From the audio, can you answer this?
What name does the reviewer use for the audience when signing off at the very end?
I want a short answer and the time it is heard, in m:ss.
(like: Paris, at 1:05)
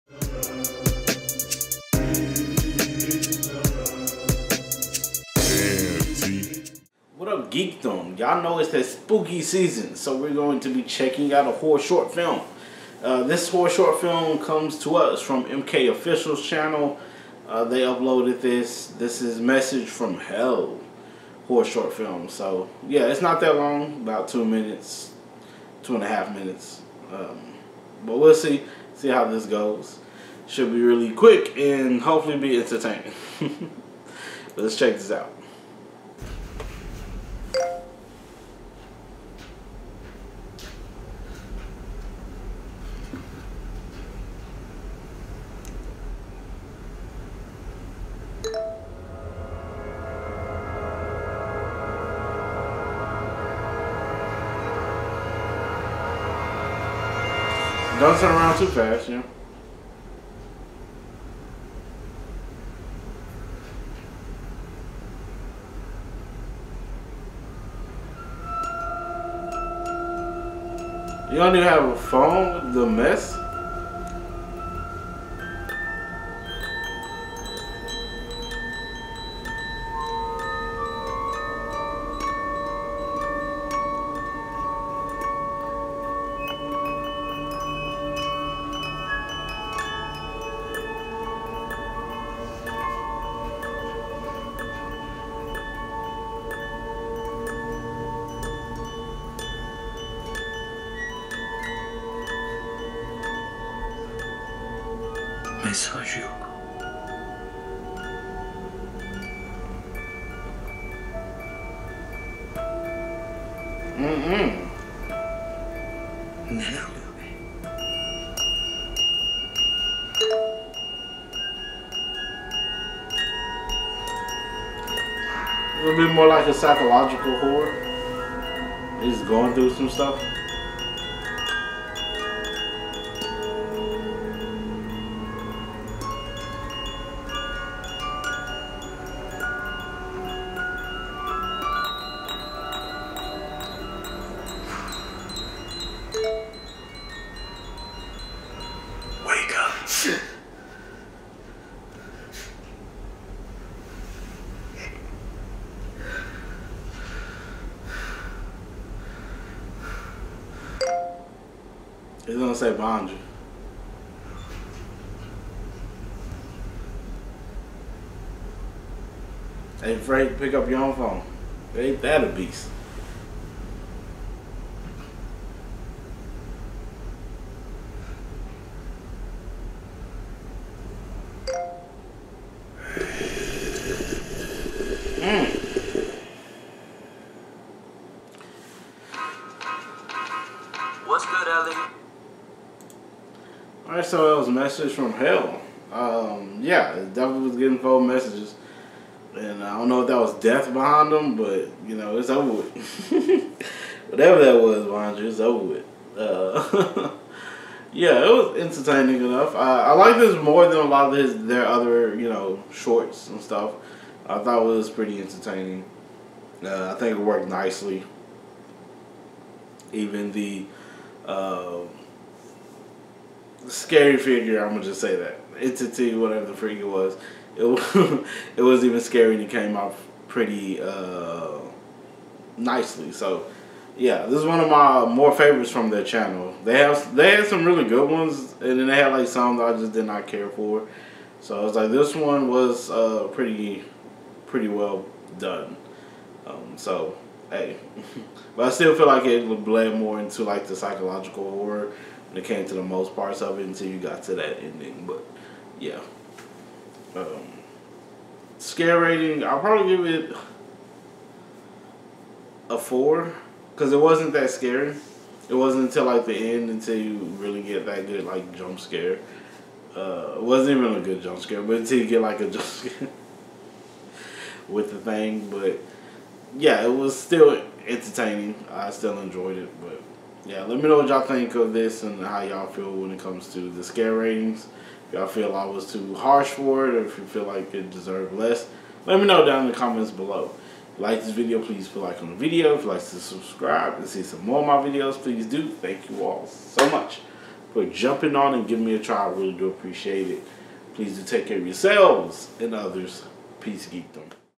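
geekdom, at 5:03.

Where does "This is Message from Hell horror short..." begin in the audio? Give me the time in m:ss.
0:18.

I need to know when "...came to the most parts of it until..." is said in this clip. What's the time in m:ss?
4:12.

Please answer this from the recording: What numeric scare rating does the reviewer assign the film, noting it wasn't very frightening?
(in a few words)
4.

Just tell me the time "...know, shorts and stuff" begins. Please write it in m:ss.
3:32.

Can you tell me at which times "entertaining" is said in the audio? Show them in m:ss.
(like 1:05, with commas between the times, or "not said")
0:32, 3:28, 3:35, 4:37.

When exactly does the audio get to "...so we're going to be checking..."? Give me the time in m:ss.
0:09.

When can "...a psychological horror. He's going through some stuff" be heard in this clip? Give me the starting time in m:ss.
2:06.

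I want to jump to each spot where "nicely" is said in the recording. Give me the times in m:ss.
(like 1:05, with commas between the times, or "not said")
3:37, 3:52.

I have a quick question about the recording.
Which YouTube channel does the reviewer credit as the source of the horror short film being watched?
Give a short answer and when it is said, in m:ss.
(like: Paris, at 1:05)
MK Official, at 0:15.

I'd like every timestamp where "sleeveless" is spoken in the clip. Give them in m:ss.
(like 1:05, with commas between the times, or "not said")
not said.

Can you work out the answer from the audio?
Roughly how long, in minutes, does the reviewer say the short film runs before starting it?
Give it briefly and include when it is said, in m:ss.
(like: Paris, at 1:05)
2.5 minutes, at 0:25.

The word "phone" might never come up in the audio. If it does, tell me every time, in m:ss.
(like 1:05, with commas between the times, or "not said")
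1:11, 2:50, 3:17.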